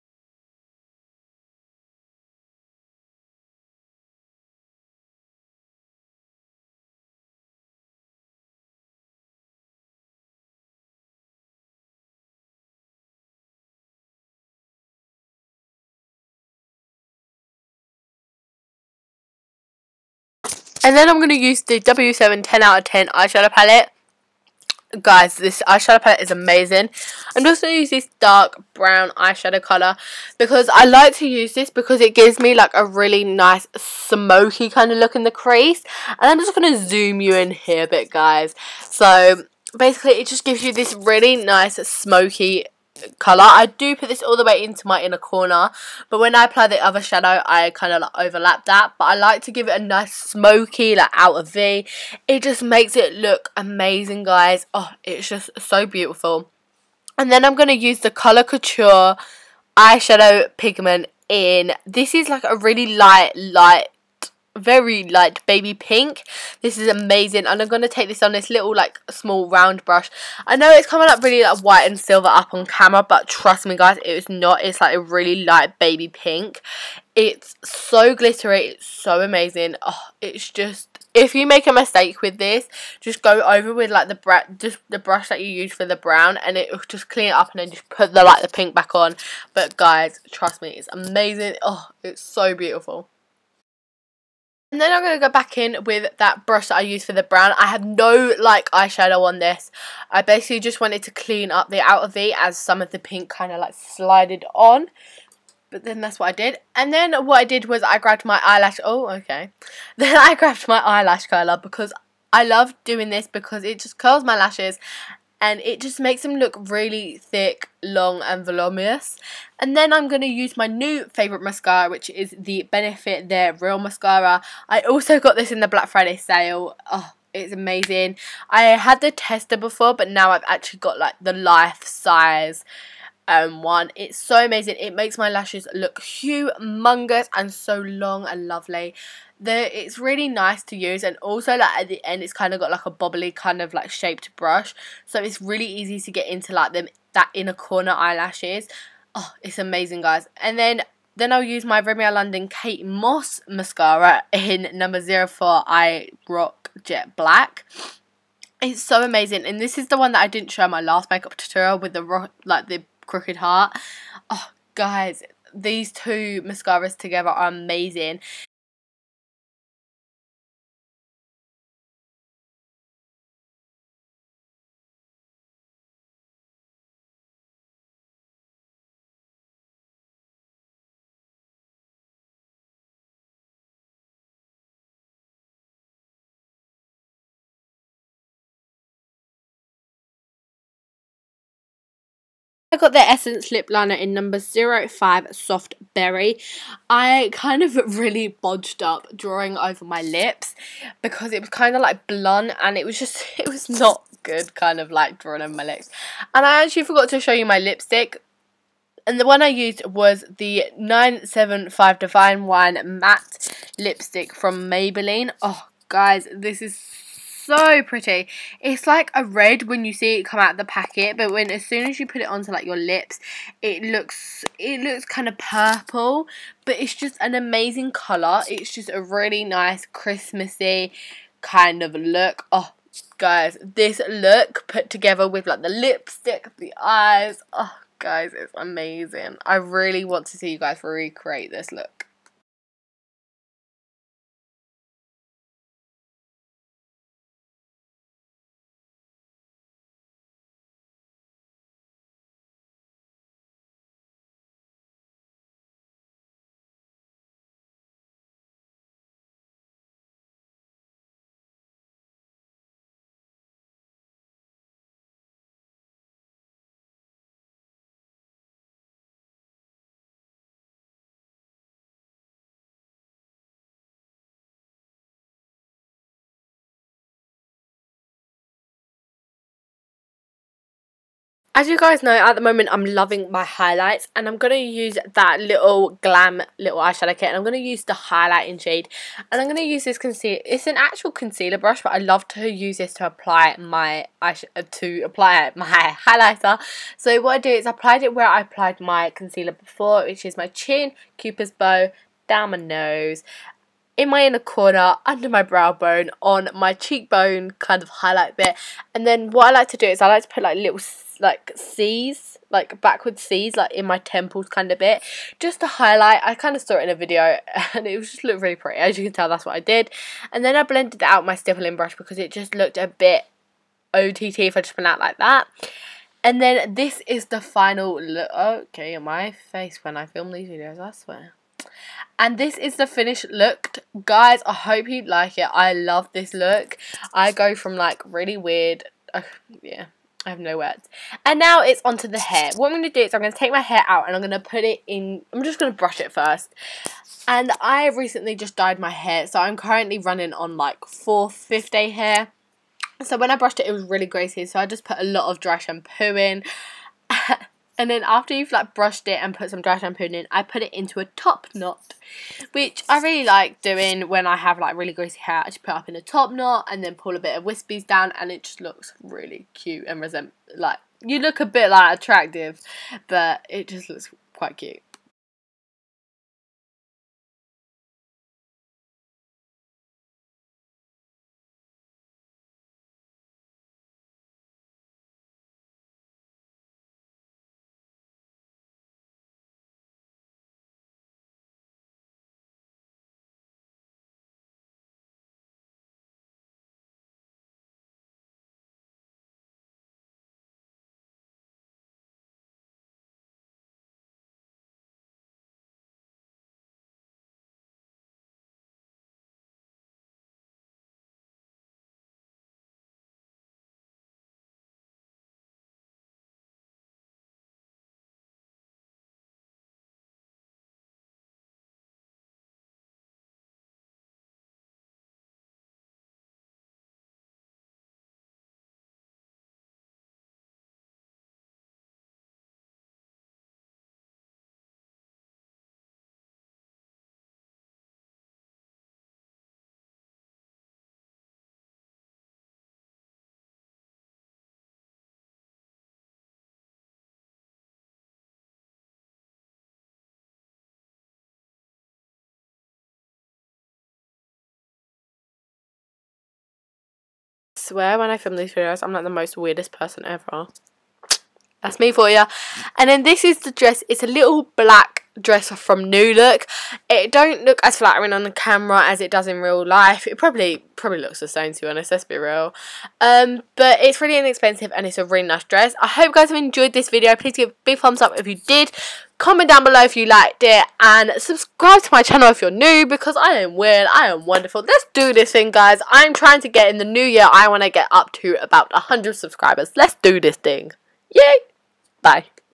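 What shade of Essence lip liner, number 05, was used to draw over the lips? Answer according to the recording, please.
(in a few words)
Soft Berry.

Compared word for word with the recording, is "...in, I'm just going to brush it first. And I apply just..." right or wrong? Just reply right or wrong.
wrong.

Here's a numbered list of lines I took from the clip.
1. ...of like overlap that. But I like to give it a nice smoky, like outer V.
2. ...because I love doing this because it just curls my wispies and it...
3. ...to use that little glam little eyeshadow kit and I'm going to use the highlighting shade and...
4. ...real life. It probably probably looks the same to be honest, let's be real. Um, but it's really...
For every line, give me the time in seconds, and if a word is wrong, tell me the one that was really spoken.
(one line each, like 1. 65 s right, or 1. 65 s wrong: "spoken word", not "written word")
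1. 47 s right
2. 111 s wrong: "lashes", not "wispies"
3. 284 s right
4. 469 s right.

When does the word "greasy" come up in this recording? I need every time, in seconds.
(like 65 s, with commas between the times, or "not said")
354 s, 364 s.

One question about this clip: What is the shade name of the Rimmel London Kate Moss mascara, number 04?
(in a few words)
I Rock Jet Black.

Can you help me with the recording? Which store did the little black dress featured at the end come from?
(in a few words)
New Look.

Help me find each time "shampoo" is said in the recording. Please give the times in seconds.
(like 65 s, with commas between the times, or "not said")
355 s, 359 s.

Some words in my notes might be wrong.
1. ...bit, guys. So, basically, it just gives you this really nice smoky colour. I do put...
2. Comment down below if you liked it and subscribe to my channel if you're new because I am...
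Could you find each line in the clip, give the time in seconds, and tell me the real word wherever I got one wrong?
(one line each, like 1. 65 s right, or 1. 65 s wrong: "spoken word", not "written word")
1. 37 s right
2. 479 s right.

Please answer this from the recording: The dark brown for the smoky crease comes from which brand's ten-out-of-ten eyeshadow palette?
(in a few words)
W7.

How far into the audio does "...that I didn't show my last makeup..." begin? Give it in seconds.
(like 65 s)
160 s.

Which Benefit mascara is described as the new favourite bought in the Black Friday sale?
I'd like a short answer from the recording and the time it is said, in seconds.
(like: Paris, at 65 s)
They're Real, at 123 s.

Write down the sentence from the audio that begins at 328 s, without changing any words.
Okay, my face when I film these videos, I swear.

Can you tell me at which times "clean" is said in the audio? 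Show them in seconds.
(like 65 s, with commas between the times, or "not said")
87 s, 101 s.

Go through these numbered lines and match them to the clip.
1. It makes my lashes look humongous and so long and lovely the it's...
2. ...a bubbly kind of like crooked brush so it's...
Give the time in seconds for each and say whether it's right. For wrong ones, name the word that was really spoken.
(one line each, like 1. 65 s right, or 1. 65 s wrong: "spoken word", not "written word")
1. 134 s right
2. 142 s wrong: "shaped", not "crooked".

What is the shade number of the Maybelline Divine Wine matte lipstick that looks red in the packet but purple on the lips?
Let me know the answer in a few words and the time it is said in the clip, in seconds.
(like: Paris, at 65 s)
975, at 210 s.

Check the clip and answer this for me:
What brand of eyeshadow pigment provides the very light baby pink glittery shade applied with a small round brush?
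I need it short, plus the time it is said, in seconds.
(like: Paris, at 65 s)
Colour Couture, at 58 s.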